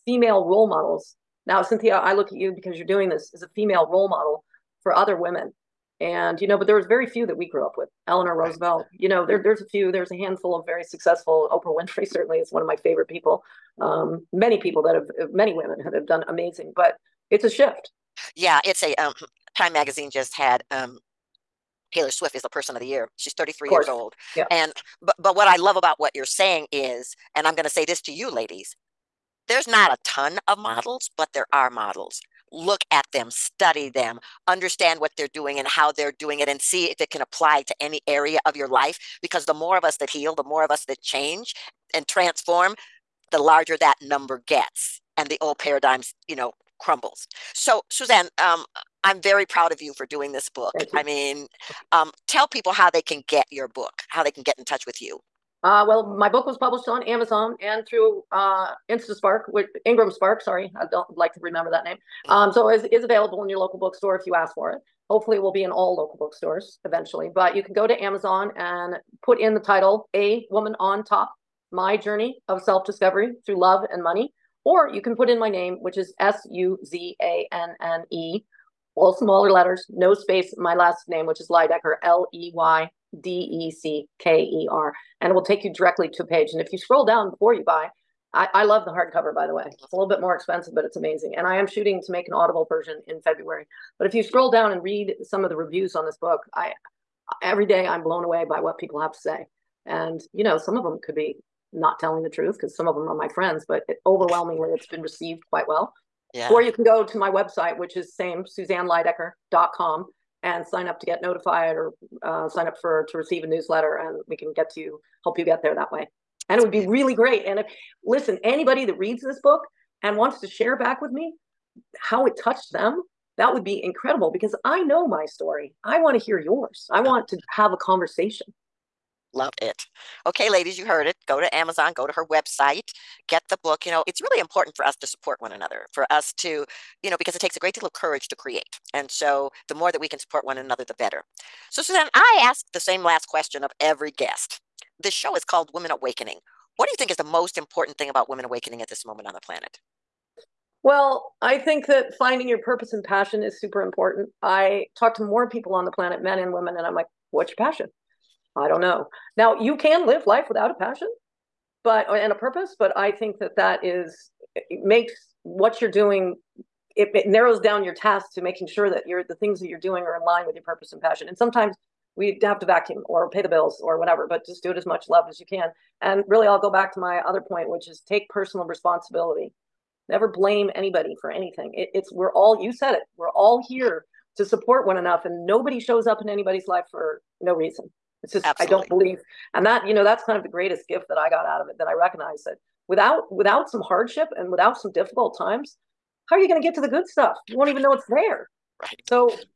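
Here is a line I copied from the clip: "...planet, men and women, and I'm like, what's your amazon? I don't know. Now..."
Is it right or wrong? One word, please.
wrong.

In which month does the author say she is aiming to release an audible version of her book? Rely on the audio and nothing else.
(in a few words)
February.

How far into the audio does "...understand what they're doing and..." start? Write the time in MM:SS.
00:34.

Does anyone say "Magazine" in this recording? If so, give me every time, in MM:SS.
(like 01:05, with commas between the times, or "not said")
00:19.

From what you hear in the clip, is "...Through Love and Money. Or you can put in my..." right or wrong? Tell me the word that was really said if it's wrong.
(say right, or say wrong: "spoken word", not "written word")
right.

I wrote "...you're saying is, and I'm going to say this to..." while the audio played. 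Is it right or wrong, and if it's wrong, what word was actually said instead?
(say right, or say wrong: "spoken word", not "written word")
right.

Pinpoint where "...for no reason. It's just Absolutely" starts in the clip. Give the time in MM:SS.
03:06.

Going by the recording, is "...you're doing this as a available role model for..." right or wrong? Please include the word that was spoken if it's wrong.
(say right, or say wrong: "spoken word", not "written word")
wrong: "female", not "available".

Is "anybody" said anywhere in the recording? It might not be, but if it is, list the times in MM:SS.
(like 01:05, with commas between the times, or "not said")
01:58, 03:00, 03:06.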